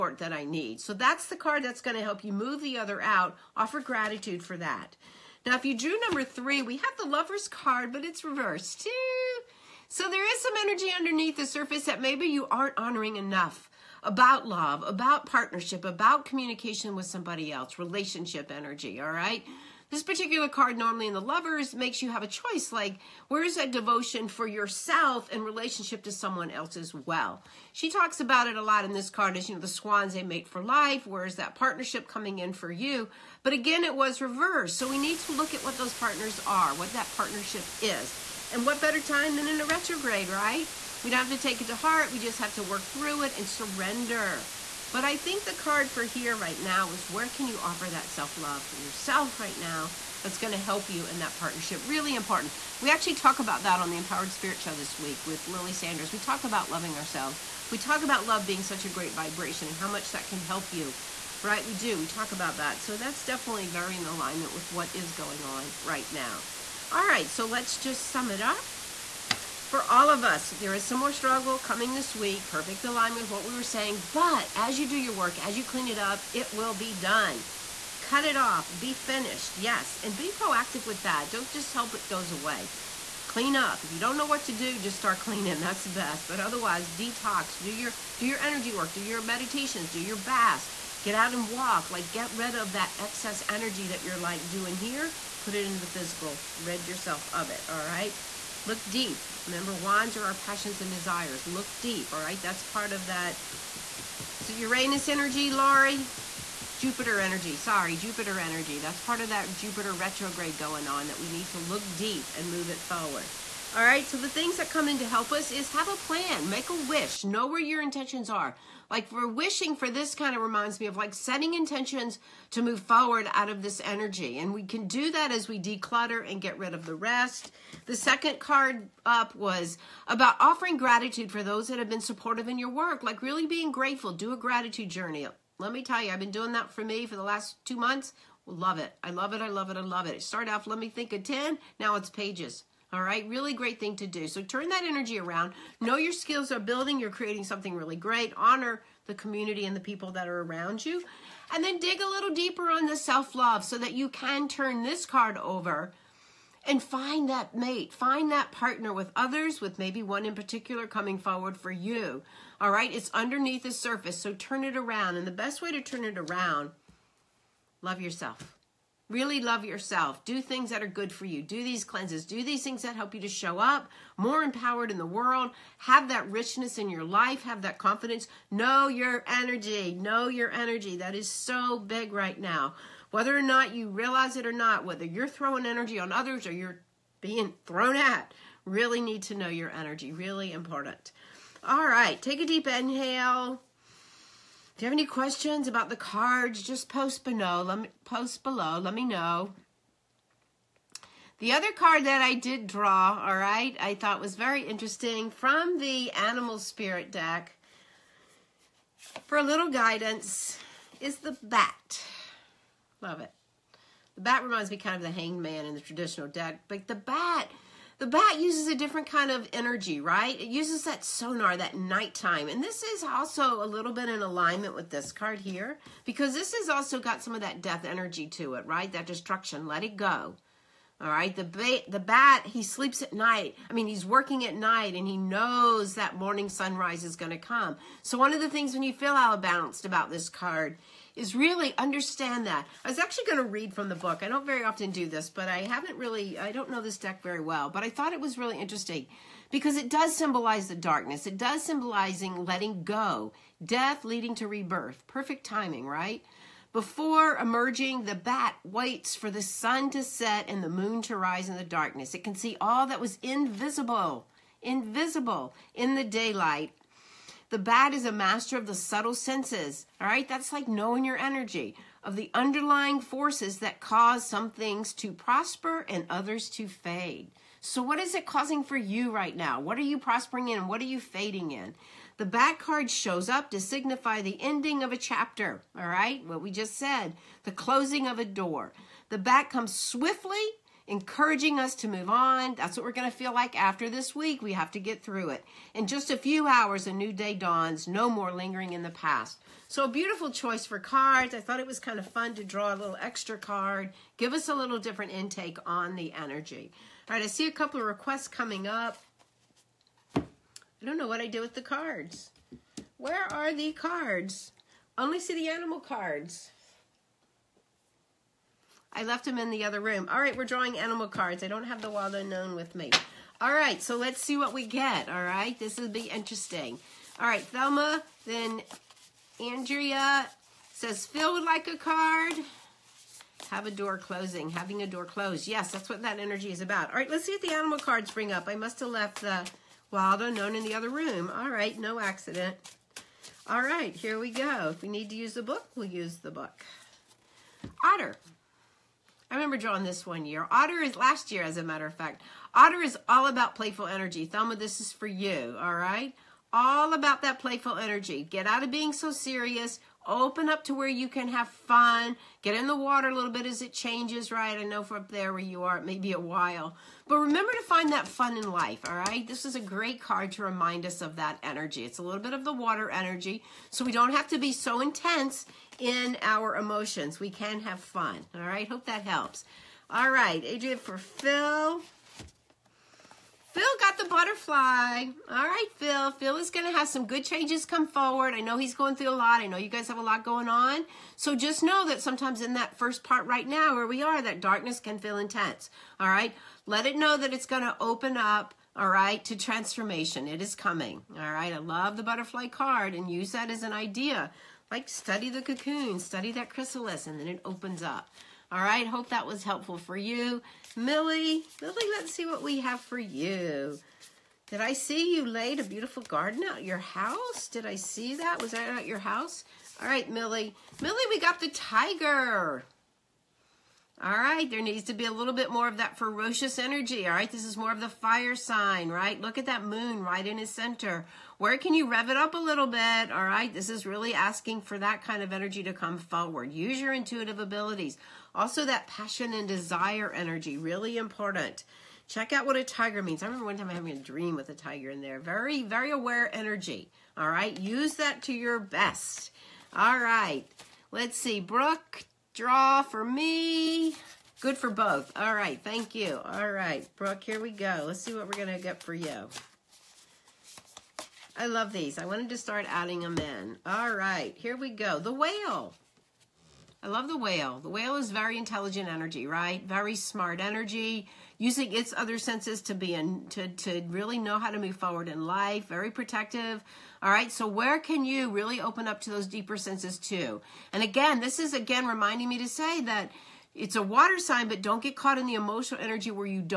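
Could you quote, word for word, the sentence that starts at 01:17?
Cut it off, be finished, yes, and be proactive with that.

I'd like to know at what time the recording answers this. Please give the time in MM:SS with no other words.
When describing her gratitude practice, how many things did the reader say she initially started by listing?
02:21.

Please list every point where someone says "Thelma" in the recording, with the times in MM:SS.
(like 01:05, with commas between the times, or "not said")
05:27, 05:54.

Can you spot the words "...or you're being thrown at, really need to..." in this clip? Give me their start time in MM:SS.
03:06.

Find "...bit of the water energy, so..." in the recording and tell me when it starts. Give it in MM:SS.
06:12.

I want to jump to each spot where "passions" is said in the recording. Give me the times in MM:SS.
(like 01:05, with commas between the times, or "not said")
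01:40, 07:18.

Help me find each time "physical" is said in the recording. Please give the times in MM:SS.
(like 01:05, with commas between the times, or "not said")
01:35.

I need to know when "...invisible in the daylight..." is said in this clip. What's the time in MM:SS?
04:24.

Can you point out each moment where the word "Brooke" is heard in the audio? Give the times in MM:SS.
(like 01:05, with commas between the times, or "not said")
07:31, 07:36.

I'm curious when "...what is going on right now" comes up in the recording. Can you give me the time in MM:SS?
01:04.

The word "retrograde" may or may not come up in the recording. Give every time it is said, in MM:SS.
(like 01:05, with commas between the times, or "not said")
00:39, 01:49.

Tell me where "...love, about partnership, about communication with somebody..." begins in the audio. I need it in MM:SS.
00:14.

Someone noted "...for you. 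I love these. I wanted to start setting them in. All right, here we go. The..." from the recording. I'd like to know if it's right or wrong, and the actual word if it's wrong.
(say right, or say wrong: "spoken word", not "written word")
wrong: "adding", not "setting".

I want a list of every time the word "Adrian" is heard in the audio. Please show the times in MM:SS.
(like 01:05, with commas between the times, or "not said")
06:20.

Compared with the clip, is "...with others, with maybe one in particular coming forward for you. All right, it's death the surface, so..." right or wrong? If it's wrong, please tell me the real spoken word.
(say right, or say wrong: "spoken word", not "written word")
wrong: "underneath", not "death".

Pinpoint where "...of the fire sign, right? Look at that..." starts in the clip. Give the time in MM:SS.
07:07.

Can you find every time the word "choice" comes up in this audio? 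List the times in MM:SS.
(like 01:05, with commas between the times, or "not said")
00:22, 05:00.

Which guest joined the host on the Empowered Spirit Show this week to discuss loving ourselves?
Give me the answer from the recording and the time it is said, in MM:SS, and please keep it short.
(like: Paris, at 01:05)
Lily Sanders, at 00:55.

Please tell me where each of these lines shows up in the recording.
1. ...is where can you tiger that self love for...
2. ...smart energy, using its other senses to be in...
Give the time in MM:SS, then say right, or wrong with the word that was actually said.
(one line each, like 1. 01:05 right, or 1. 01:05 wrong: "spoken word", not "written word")
1. 00:46 wrong: "offer", not "tiger"
2. 07:49 right.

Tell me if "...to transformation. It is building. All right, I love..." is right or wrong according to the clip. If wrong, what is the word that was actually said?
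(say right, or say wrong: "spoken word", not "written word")
wrong: "coming", not "building".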